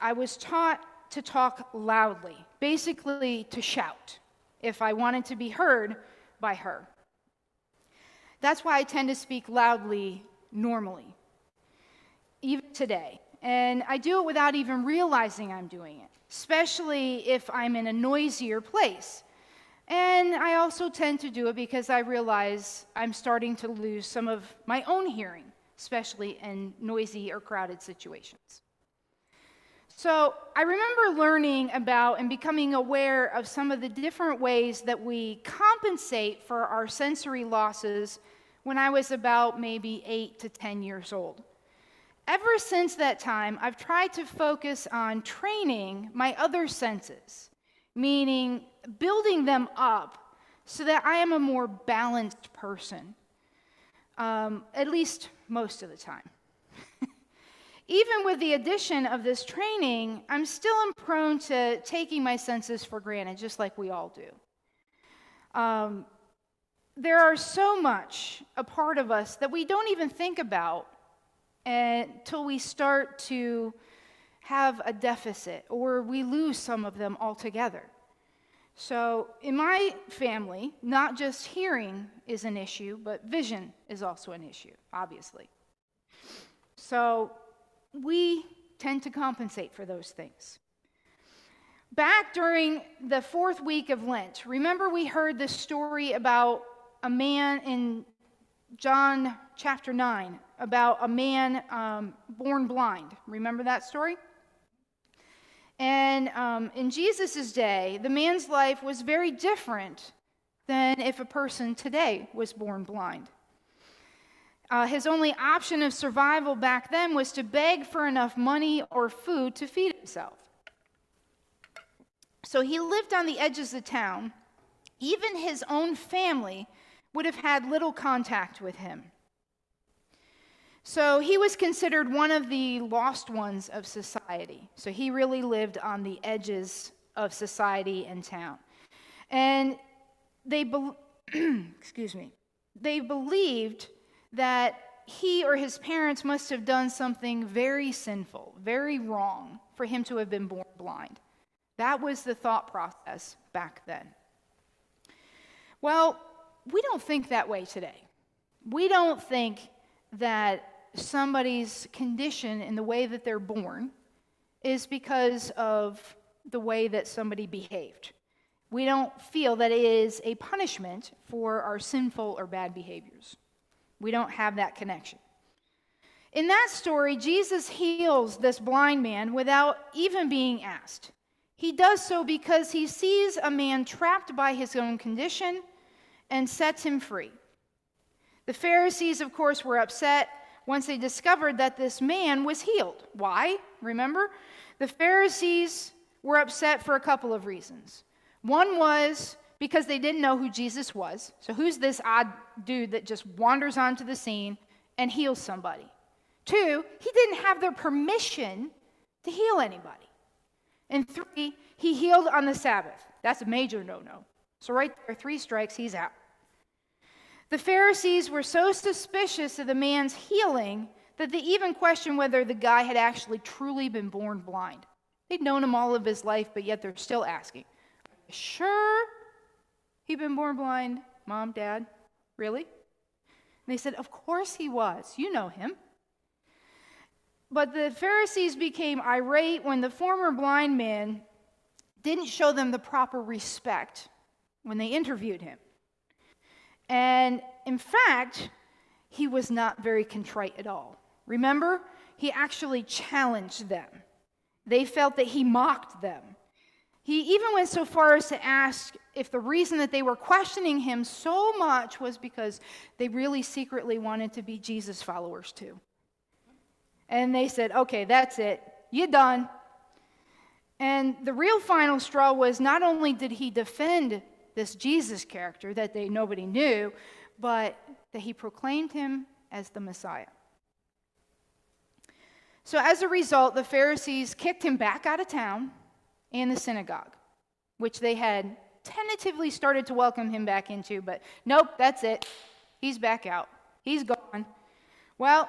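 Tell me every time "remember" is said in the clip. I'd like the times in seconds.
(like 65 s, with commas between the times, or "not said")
30 s, 94 s, 103 s, 193 s, 251 s.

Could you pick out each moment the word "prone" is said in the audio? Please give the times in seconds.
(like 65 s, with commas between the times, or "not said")
60 s.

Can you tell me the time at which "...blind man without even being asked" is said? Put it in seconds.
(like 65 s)
178 s.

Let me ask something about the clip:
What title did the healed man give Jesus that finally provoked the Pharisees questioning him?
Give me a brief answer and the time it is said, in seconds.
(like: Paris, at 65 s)
Messiah, at 279 s.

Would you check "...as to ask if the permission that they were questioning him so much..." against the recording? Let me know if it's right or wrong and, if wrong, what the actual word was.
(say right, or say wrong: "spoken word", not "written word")
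wrong: "reason", not "permission".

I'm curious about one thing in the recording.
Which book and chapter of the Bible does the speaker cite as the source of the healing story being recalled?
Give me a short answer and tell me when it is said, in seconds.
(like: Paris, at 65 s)
John chapter 9, at 98 s.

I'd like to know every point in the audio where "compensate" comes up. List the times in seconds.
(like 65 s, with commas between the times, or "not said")
35 s, 89 s.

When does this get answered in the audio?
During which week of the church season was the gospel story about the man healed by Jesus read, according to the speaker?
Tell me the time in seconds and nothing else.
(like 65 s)
93 s.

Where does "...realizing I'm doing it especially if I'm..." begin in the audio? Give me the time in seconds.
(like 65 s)
14 s.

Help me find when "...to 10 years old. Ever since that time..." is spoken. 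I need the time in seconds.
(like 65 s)
40 s.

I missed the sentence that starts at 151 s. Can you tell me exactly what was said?
That was the thought process back then.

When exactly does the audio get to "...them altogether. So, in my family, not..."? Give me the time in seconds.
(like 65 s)
76 s.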